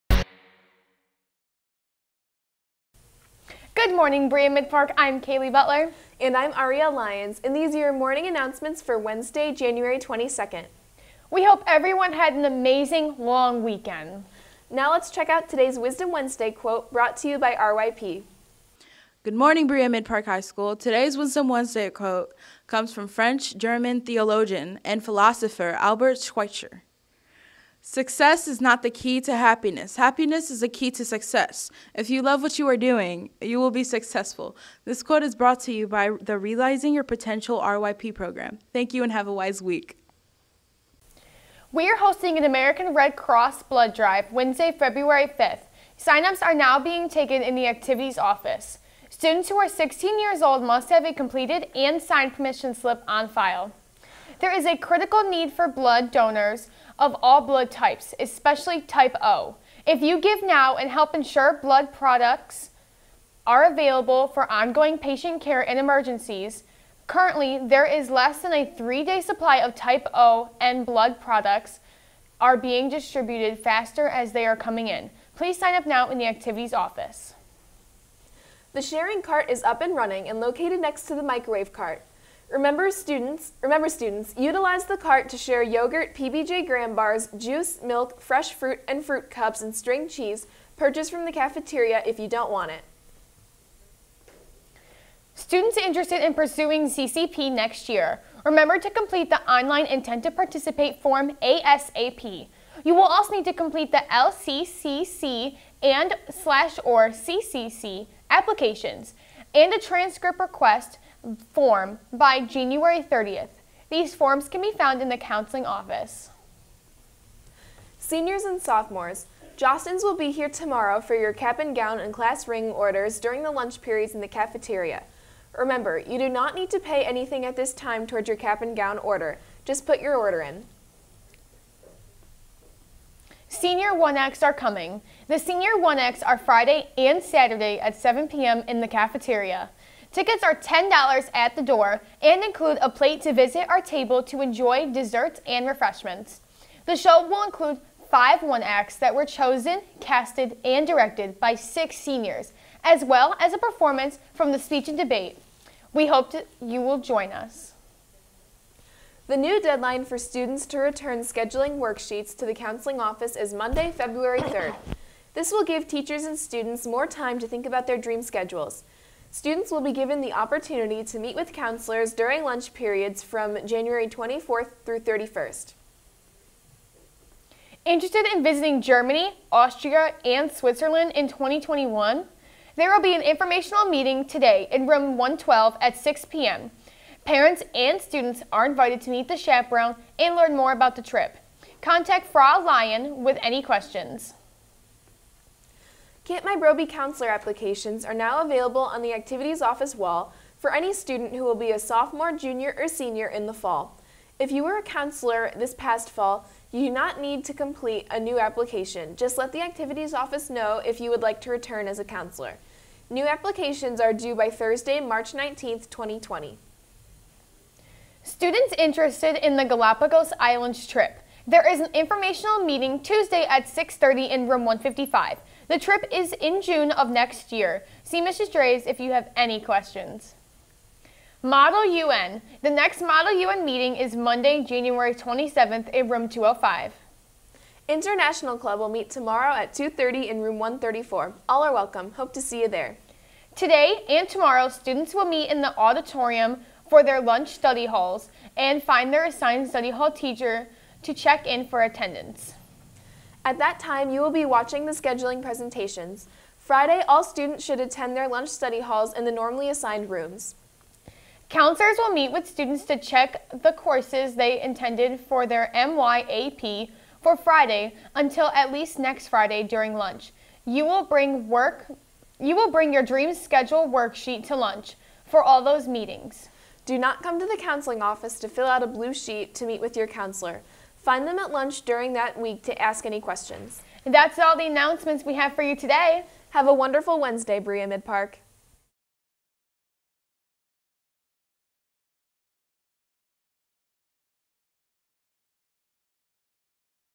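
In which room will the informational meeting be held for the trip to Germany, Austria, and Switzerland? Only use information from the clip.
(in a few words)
Room 112.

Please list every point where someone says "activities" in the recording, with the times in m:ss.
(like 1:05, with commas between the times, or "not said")
0:47, 1:16, 3:19, 3:29.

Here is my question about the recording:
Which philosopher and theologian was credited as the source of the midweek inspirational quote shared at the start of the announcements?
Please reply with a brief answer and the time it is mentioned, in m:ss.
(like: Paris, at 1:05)
Albert Schweitzer, at 0:25.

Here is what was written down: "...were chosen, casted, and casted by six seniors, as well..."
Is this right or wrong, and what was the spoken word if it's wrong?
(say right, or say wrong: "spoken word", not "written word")
wrong: "directed", not "casted".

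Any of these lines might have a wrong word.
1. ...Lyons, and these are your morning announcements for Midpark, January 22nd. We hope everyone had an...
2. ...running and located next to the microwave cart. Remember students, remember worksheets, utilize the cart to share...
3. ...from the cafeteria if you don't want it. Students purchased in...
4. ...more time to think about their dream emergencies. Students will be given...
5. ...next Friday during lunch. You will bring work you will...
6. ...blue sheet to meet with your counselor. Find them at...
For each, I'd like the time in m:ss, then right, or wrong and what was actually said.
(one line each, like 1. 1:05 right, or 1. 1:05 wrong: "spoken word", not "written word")
1. 0:06 wrong: "Wednesday", not "Midpark"
2. 1:19 wrong: "students", not "worksheets"
3. 1:31 wrong: "interested", not "purchased"
4. 2:46 wrong: "schedules", not "emergencies"
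5. 4:28 right
6. 4:38 right.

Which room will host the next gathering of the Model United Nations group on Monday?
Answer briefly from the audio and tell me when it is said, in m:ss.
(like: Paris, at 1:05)
Room 205, at 3:56.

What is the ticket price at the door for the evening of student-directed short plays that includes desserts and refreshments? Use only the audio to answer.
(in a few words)
$10.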